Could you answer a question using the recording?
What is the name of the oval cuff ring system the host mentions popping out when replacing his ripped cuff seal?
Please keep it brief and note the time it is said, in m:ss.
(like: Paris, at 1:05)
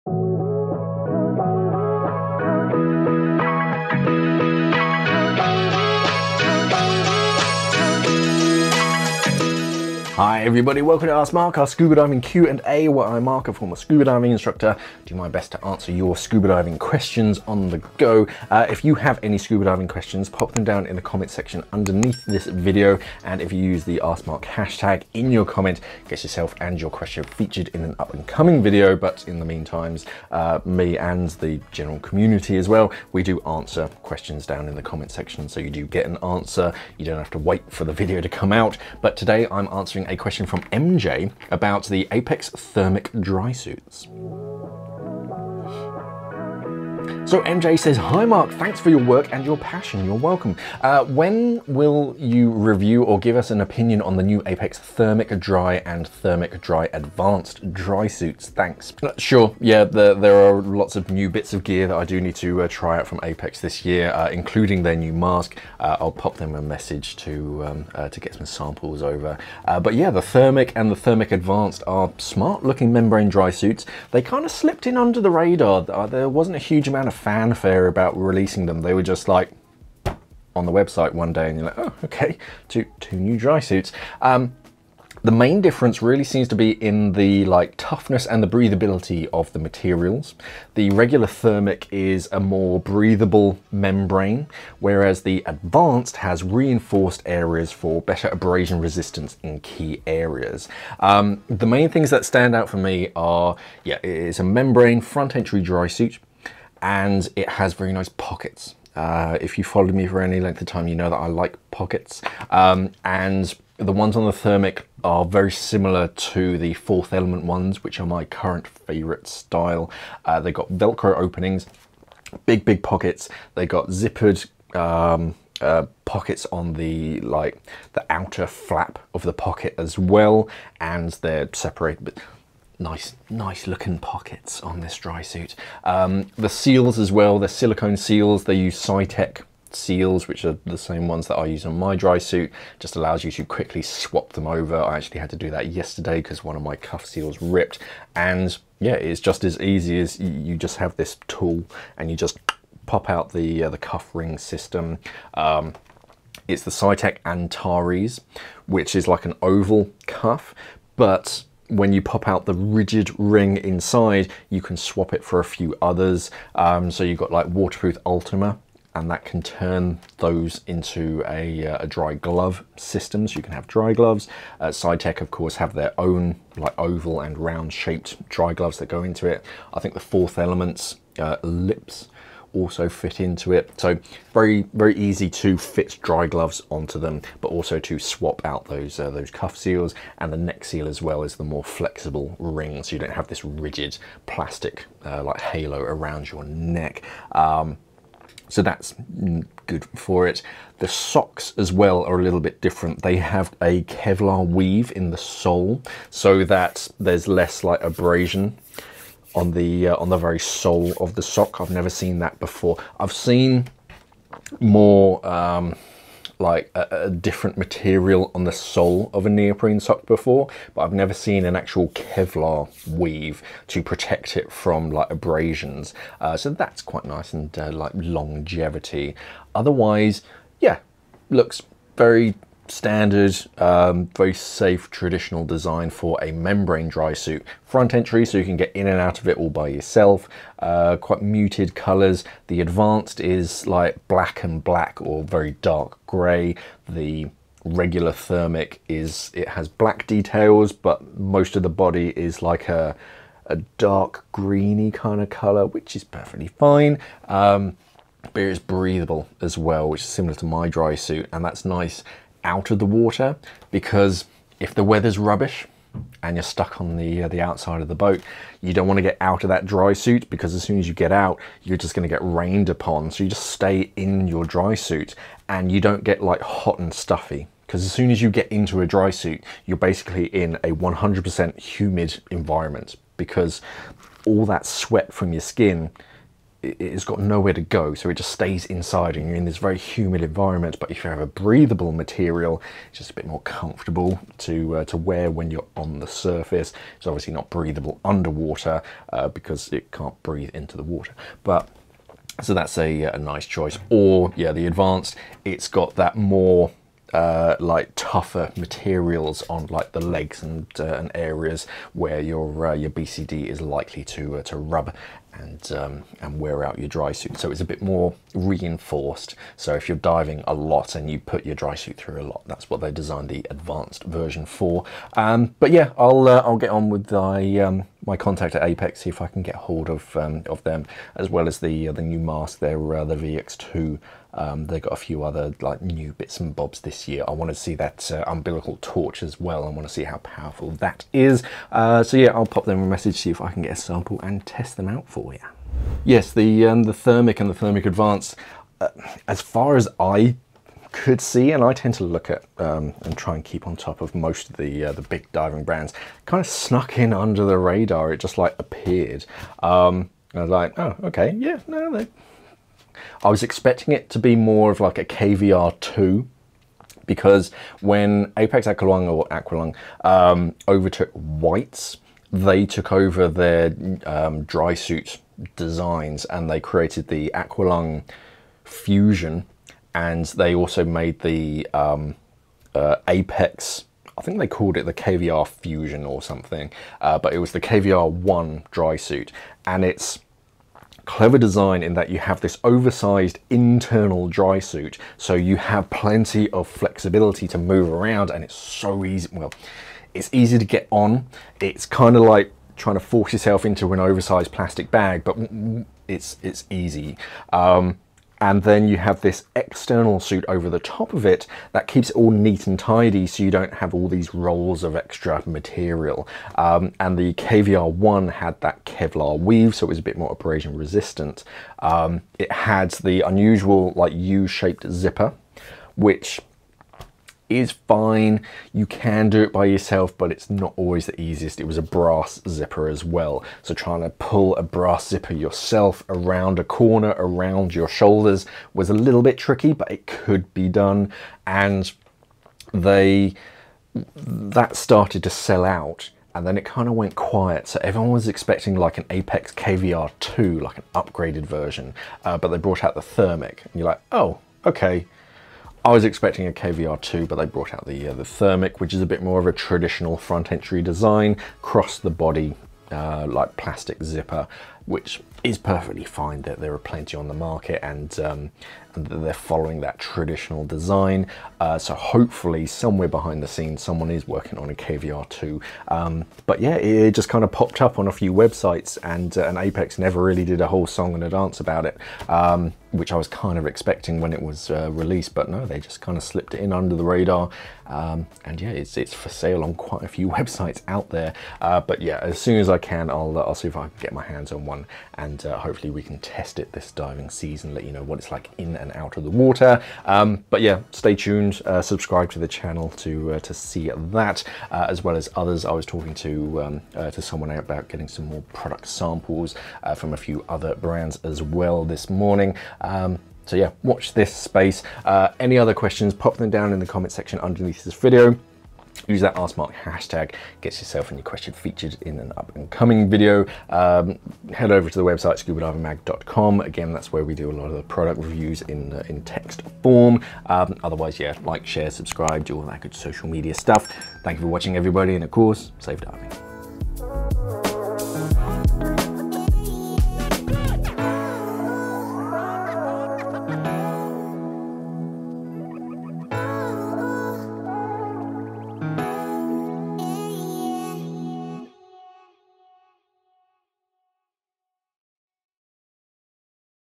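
Antares, at 2:37.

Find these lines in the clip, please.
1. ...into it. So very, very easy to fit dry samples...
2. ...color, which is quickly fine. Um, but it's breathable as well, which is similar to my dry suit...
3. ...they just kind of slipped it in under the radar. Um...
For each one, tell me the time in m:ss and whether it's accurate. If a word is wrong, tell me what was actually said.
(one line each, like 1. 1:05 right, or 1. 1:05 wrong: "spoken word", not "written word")
1. 3:03 wrong: "gloves", not "samples"
2. 4:15 wrong: "perfectly", not "quickly"
3. 8:05 right.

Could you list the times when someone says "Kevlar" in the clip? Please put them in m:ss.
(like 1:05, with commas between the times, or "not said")
3:23, 3:41, 6:58.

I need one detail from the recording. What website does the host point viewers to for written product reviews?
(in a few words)
scubadivingmag.com.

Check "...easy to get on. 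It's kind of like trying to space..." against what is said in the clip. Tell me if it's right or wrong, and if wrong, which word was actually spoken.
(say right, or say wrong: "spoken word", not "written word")
wrong: "force", not "space".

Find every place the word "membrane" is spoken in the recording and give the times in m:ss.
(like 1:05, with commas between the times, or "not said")
1:12, 1:33, 1:44, 3:56.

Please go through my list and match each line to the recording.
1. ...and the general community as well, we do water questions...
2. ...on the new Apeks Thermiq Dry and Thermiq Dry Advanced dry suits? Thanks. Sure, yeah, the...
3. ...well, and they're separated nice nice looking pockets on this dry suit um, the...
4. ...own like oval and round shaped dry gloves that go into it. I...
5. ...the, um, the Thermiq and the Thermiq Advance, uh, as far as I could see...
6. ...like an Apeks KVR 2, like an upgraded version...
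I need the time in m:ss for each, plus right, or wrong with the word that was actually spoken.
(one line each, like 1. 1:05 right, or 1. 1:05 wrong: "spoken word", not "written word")
1. 0:30 wrong: "answer", not "water"
2. 0:54 right
3. 2:09 right
4. 2:55 right
5. 5:46 right
6. 7:28 right.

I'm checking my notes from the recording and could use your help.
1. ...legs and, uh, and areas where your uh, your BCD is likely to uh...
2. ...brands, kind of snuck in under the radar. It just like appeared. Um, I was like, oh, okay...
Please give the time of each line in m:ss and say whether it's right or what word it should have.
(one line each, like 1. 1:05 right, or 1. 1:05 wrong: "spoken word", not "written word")
1. 5:09 right
2. 5:55 right.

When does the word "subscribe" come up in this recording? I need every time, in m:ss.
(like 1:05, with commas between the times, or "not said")
8:21, 8:51.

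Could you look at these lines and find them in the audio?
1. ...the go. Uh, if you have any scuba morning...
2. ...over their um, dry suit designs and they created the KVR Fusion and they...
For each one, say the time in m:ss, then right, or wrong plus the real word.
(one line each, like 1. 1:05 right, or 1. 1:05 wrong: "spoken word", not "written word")
1. 0:17 wrong: "diving", not "morning"
2. 6:12 wrong: "Aqualung", not "KVR".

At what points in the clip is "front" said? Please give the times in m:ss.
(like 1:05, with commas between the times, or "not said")
1:45, 3:57, 7:40.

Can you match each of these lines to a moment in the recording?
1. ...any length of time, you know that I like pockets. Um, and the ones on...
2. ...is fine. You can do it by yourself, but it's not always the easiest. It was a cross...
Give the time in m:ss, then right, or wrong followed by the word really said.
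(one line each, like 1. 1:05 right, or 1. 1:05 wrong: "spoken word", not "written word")
1. 1:50 right
2. 7:07 wrong: "brass", not "cross".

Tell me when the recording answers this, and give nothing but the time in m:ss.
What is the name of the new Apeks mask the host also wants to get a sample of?
5:33.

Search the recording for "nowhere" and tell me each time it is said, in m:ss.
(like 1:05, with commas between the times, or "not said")
4:47.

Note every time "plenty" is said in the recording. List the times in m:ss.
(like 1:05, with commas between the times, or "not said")
6:35, 7:46.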